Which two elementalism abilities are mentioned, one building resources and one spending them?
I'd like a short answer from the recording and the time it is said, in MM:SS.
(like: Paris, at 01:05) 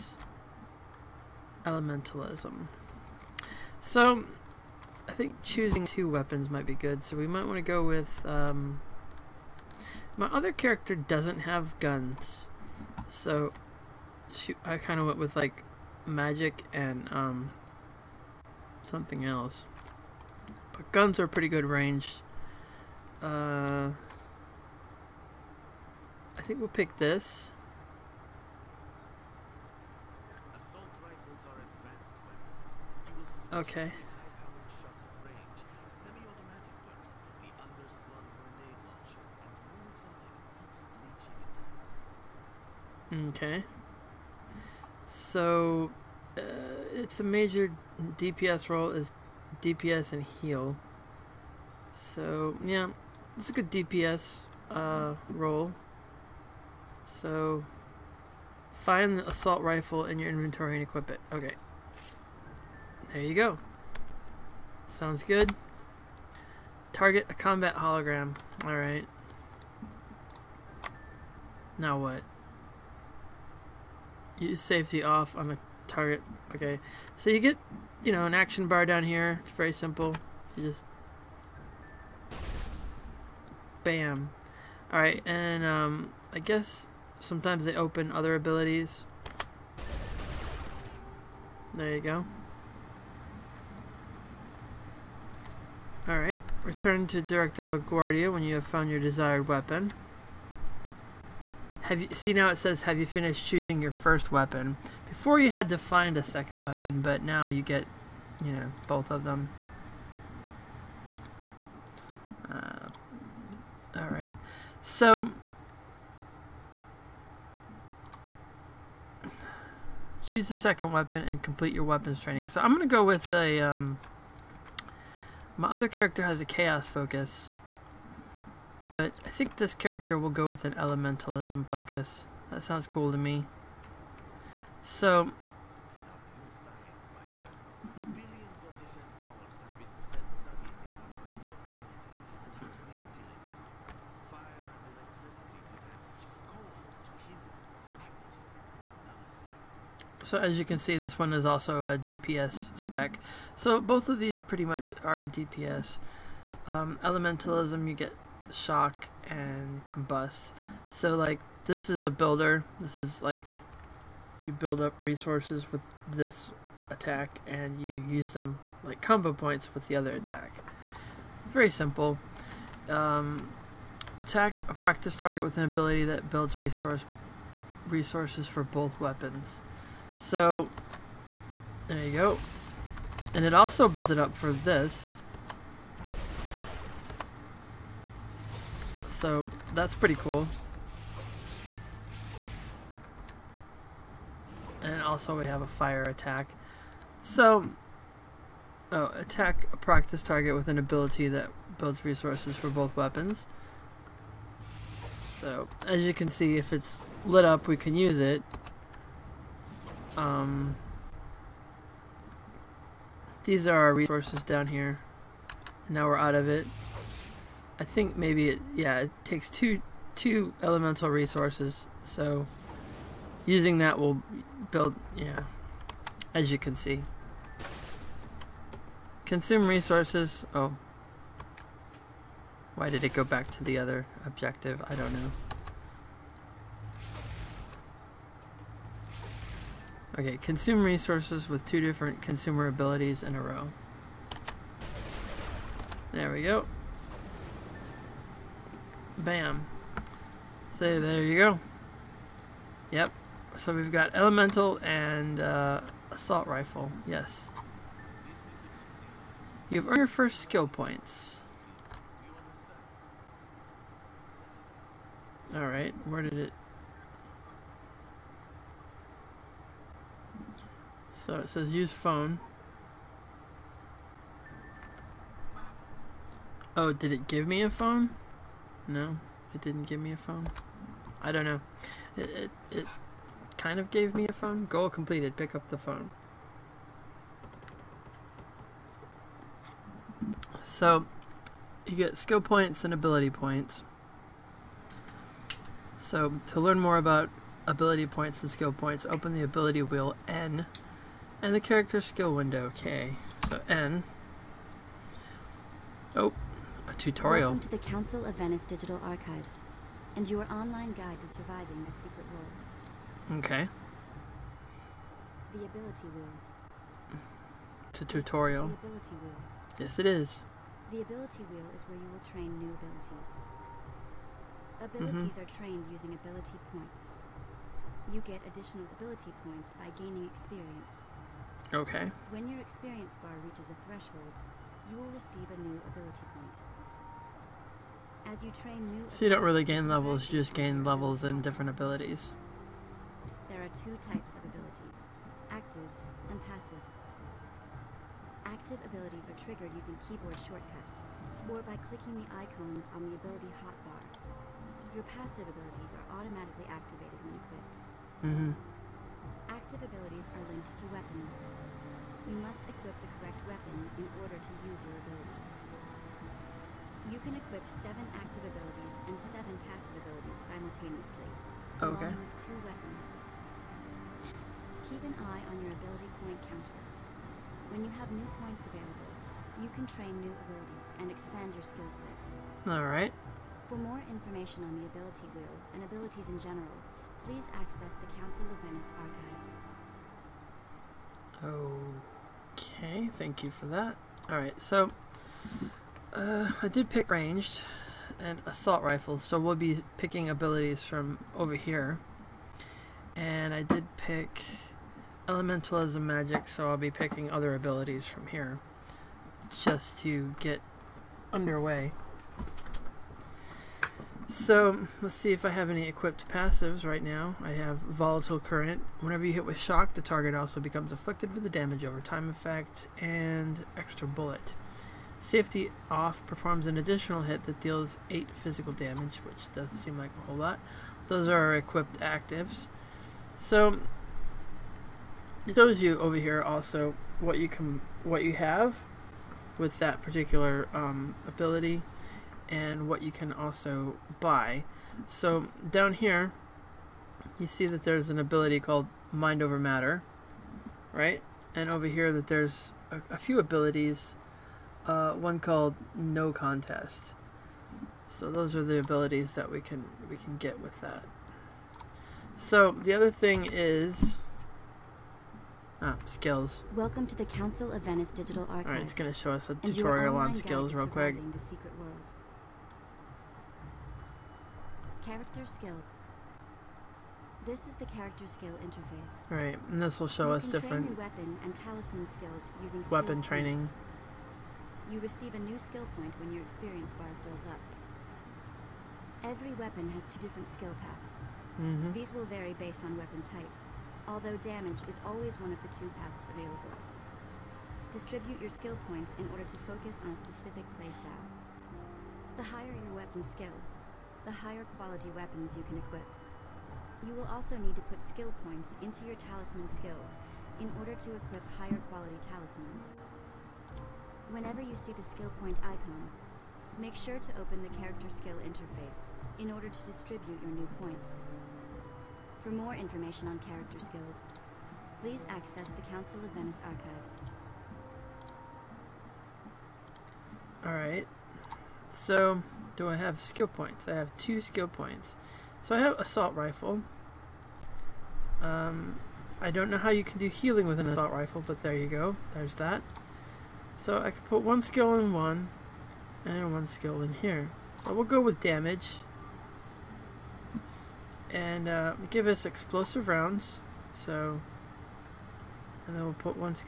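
Shock and combust, at 02:38.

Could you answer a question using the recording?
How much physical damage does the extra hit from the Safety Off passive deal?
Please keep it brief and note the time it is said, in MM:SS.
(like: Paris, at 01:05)
8, at 07:08.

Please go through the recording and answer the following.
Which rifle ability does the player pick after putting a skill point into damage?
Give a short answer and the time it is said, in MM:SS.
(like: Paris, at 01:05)
Explosive rounds, at 09:12.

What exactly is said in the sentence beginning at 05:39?
So you don't really gain levels, you just gain levels and different abilities.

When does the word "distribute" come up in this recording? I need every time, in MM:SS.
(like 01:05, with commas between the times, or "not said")
08:17, 08:39.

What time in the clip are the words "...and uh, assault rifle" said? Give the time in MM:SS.
04:14.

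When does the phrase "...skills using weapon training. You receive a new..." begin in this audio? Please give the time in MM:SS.
08:02.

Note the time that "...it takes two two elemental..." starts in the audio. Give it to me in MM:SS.
03:38.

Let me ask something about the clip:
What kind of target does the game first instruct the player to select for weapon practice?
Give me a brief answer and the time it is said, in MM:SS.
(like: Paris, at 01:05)
Combat hologram, at 01:07.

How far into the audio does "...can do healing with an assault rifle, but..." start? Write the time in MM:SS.
09:00.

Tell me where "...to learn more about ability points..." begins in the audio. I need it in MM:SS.
04:56.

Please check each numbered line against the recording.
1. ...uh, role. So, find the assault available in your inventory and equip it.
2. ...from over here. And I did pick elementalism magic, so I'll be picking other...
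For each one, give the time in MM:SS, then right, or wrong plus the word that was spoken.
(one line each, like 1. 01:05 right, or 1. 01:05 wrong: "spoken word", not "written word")
1. 00:54 wrong: "rifle", not "available"
2. 06:40 right.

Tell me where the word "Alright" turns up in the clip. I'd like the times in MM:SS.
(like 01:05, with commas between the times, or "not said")
01:08, 01:36, 04:25, 06:22, 06:34, 08:50.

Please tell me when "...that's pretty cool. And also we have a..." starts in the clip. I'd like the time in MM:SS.
03:09.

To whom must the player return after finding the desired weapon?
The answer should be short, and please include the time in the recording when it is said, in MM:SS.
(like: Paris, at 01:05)
Director LaGuardia, at 01:37.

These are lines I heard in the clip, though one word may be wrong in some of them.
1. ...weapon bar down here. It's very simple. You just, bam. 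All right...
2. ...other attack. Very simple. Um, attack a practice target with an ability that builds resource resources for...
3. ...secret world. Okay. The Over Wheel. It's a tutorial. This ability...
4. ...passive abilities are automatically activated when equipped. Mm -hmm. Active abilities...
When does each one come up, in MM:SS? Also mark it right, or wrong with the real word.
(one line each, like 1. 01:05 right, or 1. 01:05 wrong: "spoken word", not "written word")
1. 01:18 wrong: "action", not "weapon"
2. 02:49 right
3. 05:11 wrong: "Ability", not "Over"
4. 05:55 right.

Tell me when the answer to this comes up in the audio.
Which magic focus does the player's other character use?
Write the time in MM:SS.
02:06.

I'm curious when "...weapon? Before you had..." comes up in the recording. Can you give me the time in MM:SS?
01:44.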